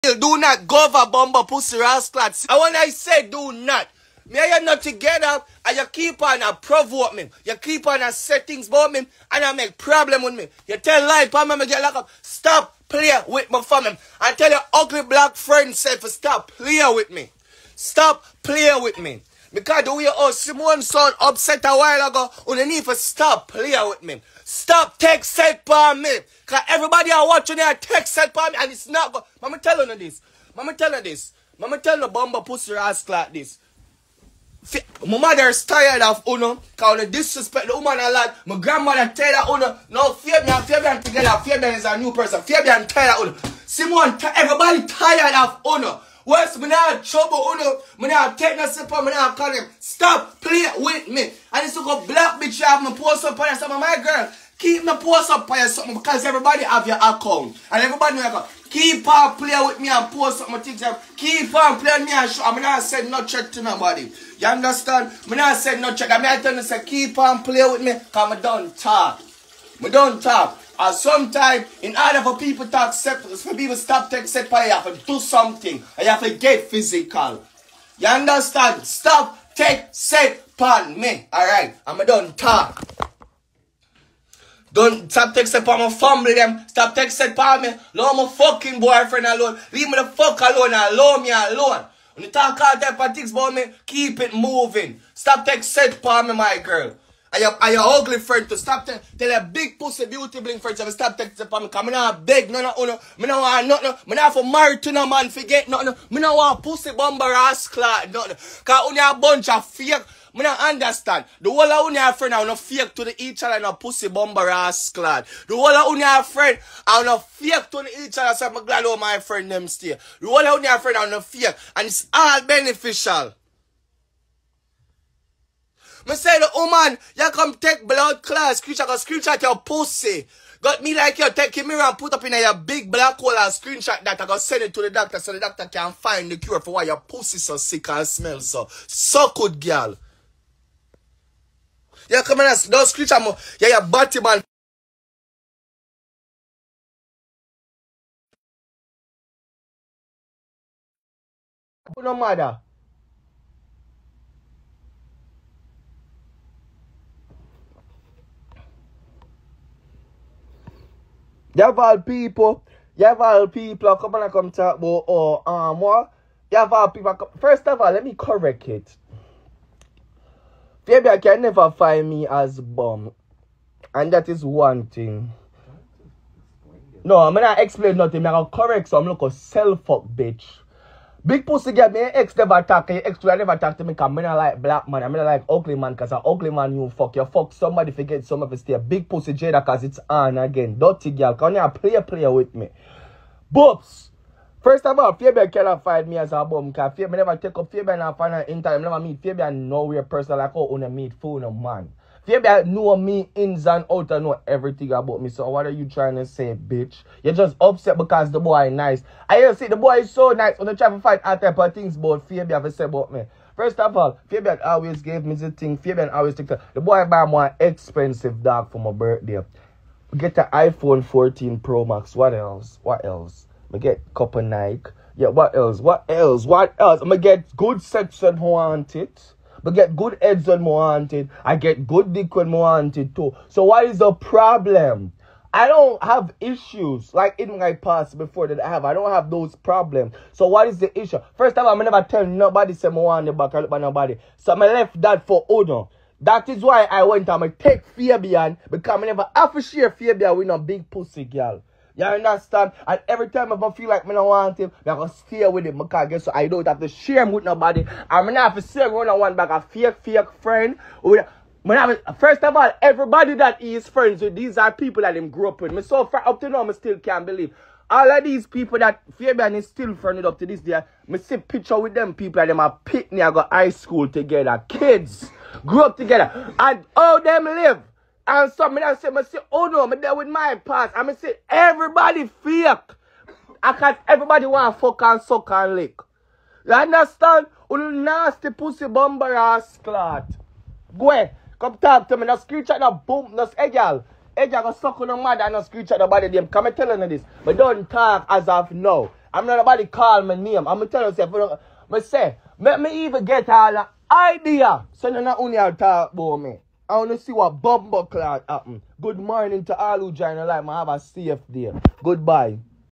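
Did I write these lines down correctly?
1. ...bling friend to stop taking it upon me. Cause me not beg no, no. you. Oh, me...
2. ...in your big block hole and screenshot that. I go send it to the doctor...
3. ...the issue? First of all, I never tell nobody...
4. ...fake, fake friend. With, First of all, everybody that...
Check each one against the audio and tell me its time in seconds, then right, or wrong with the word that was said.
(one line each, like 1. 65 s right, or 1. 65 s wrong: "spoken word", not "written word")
1. 100 s right
2. 132 s wrong: "black", not "block"
3. 240 s right
4. 259 s right.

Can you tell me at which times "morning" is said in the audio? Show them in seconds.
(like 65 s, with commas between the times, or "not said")
309 s.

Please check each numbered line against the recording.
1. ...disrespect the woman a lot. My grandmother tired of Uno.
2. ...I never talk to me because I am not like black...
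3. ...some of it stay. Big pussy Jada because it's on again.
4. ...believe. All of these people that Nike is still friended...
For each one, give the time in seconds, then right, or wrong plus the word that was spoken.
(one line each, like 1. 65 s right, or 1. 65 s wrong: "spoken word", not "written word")
1. 37 s right
2. 183 s right
3. 188 s right
4. 267 s wrong: "Fabian", not "Nike".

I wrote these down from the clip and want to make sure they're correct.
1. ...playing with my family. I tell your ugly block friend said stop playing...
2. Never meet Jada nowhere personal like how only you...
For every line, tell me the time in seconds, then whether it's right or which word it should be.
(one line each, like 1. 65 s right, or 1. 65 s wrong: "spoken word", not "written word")
1. 12 s wrong: "black", not "block"
2. 198 s wrong: "Fabian", not "Jada".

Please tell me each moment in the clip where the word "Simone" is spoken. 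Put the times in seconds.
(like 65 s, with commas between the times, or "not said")
20 s, 43 s.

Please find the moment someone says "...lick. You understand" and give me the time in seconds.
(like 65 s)
285 s.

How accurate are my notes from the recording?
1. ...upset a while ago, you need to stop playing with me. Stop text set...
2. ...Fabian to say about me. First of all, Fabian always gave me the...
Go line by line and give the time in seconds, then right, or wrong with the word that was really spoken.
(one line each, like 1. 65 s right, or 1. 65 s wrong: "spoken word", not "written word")
1. 21 s right
2. 212 s right.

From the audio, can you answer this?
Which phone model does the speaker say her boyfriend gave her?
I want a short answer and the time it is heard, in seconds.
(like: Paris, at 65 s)
iPhone 14 Pro Max, at 220 s.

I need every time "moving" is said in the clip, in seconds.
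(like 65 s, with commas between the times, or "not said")
94 s.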